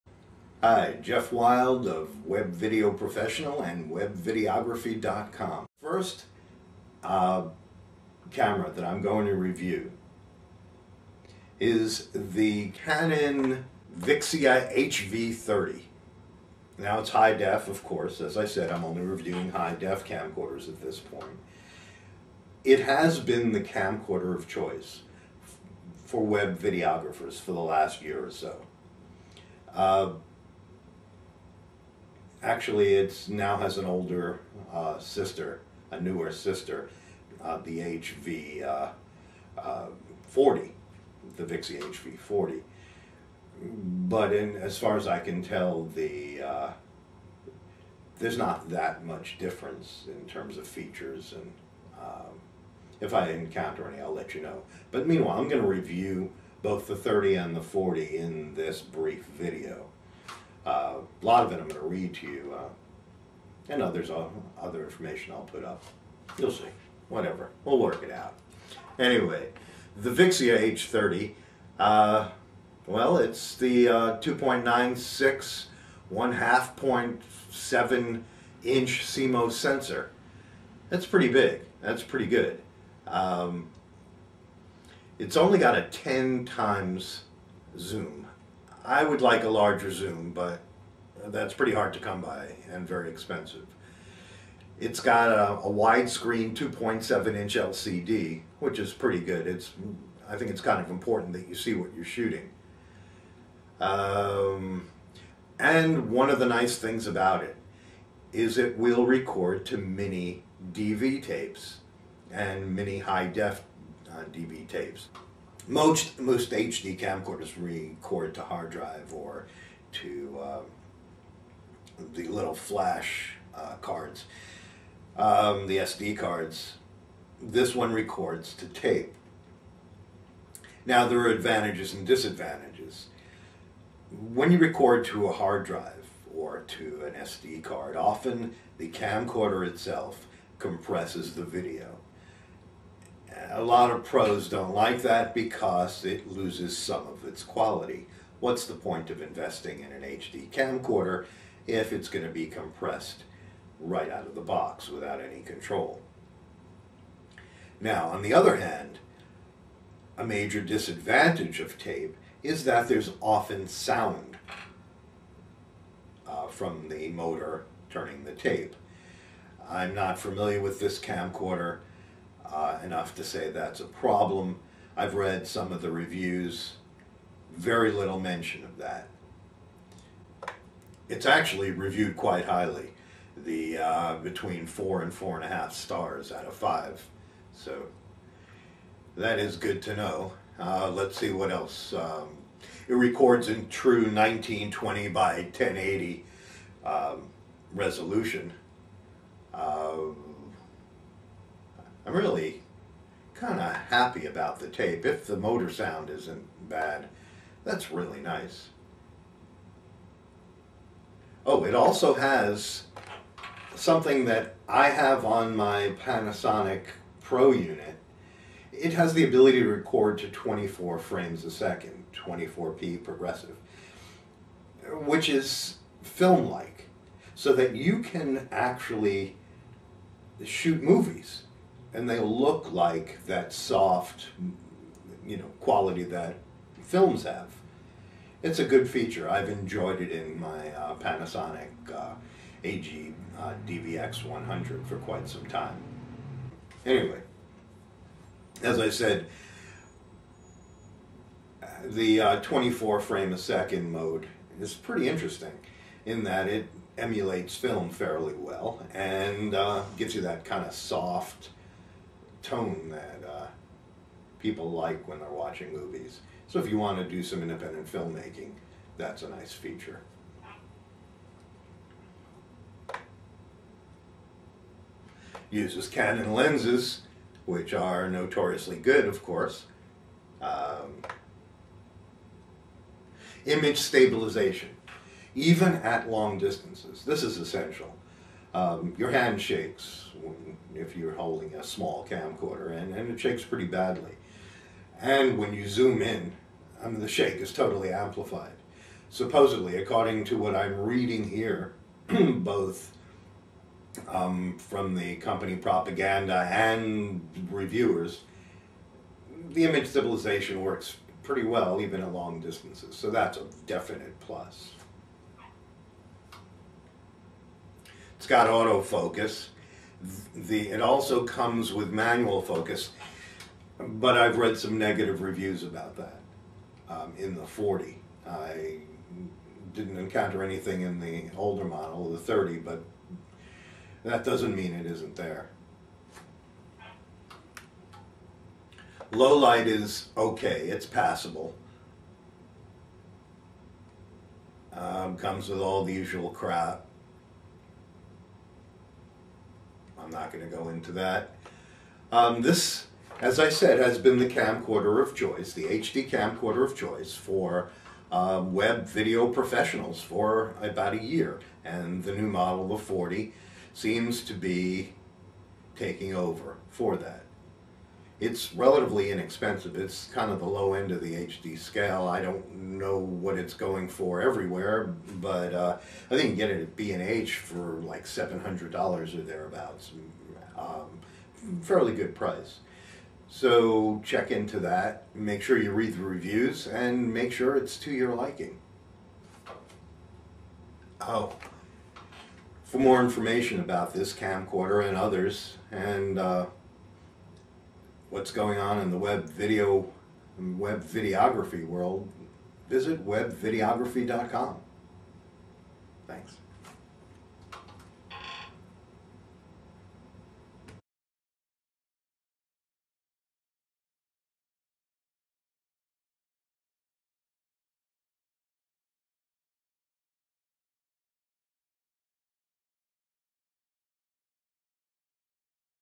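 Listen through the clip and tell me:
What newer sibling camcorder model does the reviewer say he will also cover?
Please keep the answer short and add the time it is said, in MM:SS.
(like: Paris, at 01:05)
HV40, at 00:37.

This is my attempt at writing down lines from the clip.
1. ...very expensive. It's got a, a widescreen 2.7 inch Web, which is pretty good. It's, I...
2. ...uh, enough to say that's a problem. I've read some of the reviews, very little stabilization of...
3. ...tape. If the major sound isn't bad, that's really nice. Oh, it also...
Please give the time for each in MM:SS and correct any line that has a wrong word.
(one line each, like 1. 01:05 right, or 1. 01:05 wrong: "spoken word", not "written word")
1. 01:32 wrong: "LCD", not "Web"
2. 02:52 wrong: "mention", not "stabilization"
3. 03:24 wrong: "motor", not "major".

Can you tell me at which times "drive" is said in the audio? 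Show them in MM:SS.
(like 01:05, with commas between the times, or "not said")
01:58, 02:15.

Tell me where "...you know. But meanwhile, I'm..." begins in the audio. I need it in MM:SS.
00:54.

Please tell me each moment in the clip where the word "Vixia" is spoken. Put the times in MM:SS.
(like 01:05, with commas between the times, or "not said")
00:13, 00:41, 01:10.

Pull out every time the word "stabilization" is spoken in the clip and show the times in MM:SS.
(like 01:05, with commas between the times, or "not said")
04:43, 05:09.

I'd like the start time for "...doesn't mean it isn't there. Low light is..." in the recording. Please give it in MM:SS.
05:34.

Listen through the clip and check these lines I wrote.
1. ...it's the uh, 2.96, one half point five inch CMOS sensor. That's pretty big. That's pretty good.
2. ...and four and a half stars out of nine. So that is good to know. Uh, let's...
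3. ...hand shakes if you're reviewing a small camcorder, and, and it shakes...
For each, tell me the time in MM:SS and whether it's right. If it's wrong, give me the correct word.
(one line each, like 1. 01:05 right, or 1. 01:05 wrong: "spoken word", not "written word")
1. 01:13 wrong: "seven", not "five"
2. 03:05 wrong: "five", not "nine"
3. 04:49 wrong: "holding", not "reviewing".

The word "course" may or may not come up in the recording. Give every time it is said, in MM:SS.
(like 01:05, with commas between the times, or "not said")
00:17, 04:39.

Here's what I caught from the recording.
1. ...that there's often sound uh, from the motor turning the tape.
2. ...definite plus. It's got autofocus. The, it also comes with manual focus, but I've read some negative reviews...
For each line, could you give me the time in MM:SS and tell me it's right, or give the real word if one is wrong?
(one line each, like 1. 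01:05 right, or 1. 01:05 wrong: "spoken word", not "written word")
1. 02:42 right
2. 05:13 right.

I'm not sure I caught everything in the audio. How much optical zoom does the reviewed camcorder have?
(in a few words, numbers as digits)
10 times.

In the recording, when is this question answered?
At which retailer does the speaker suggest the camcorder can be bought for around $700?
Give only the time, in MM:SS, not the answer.
06:16.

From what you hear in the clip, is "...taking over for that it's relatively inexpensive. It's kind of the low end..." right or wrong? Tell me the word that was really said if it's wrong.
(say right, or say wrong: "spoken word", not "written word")
right.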